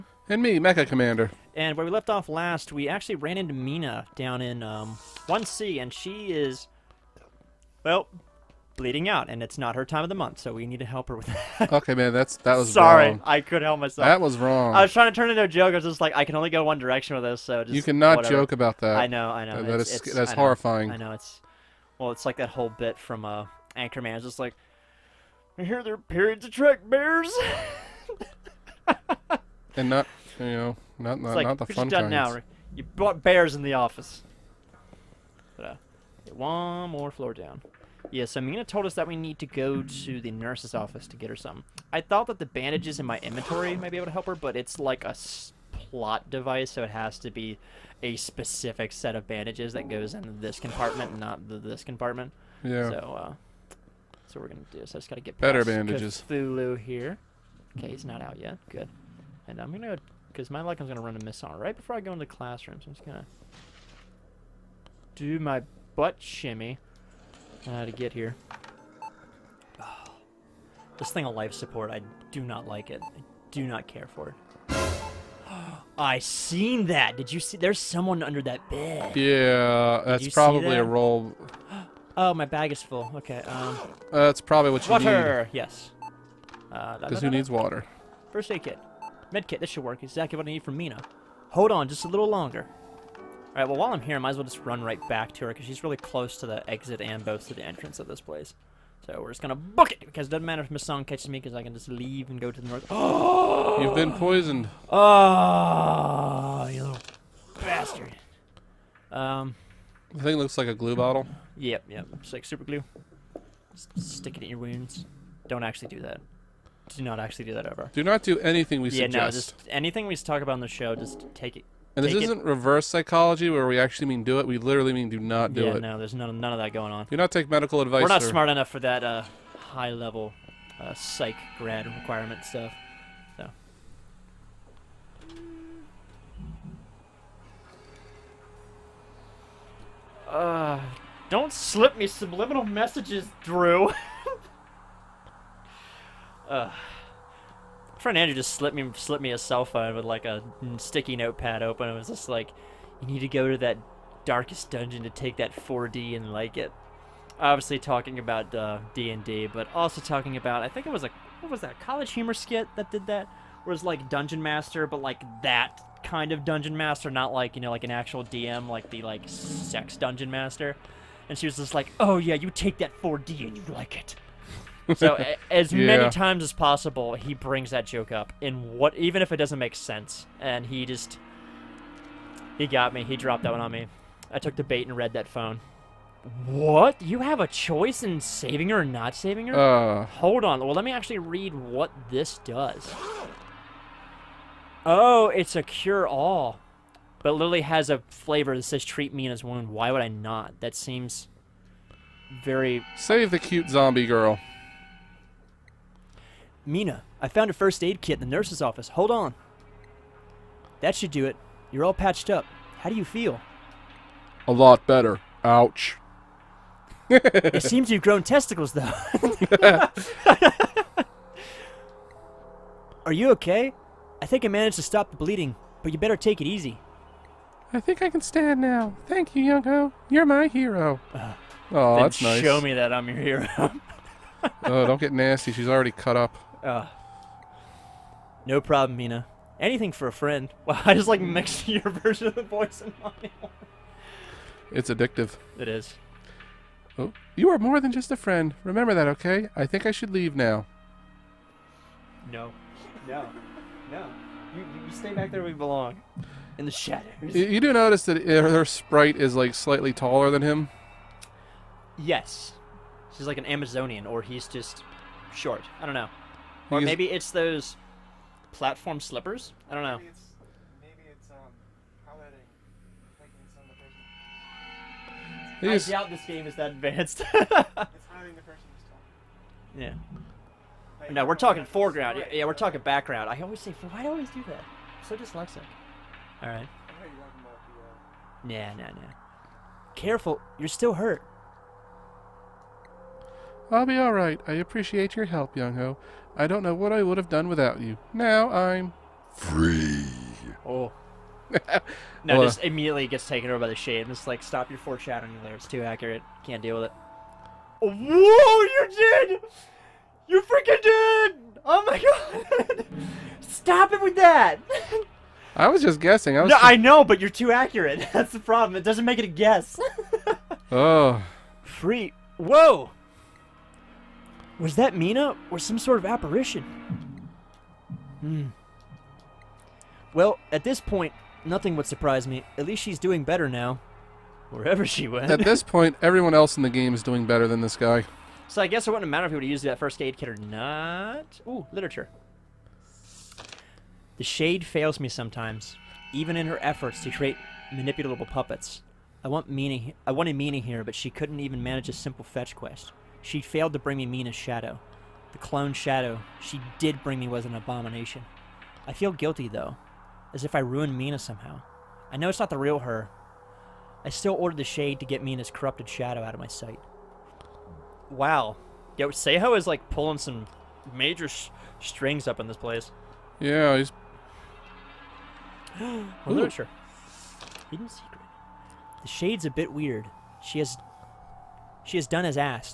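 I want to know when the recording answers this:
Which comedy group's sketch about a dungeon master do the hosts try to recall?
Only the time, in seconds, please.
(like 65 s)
161 s.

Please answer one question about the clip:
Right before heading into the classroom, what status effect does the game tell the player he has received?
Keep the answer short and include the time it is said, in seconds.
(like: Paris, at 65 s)
Poisoned, at 104 s.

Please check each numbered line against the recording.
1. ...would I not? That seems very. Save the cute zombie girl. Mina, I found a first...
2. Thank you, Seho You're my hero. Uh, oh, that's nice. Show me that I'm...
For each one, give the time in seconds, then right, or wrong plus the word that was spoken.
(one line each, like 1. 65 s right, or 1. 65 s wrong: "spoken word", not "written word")
1. 199 s right
2. 229 s wrong: "Young", not "Seho".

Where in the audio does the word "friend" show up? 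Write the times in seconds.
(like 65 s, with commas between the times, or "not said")
147 s, 240 s, 248 s.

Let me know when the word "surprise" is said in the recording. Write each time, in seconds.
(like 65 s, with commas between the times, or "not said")
331 s.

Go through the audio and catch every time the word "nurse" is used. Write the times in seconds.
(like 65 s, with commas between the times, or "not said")
40 s, 208 s.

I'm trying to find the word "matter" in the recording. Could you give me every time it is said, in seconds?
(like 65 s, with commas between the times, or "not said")
100 s, 339 s.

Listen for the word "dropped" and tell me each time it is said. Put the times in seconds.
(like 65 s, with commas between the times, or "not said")
183 s.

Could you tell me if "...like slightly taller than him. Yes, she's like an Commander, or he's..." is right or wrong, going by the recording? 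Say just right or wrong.
wrong.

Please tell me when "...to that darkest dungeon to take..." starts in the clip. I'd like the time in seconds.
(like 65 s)
153 s.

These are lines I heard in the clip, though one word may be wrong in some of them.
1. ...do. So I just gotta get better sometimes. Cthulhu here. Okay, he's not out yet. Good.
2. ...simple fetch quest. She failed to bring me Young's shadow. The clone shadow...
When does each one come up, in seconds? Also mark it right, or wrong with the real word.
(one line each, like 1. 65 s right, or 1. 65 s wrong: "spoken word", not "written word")
1. 54 s wrong: "bandages", not "sometimes"
2. 351 s wrong: "Mina", not "Young".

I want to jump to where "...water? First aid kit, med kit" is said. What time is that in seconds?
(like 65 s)
87 s.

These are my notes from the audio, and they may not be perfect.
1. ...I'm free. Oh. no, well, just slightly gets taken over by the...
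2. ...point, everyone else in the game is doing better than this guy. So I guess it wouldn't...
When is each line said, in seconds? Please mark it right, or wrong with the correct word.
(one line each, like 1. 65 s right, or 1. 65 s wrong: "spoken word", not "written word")
1. 298 s wrong: "immediately", not "slightly"
2. 335 s right.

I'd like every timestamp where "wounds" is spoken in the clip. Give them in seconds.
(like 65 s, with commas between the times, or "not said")
114 s, 199 s.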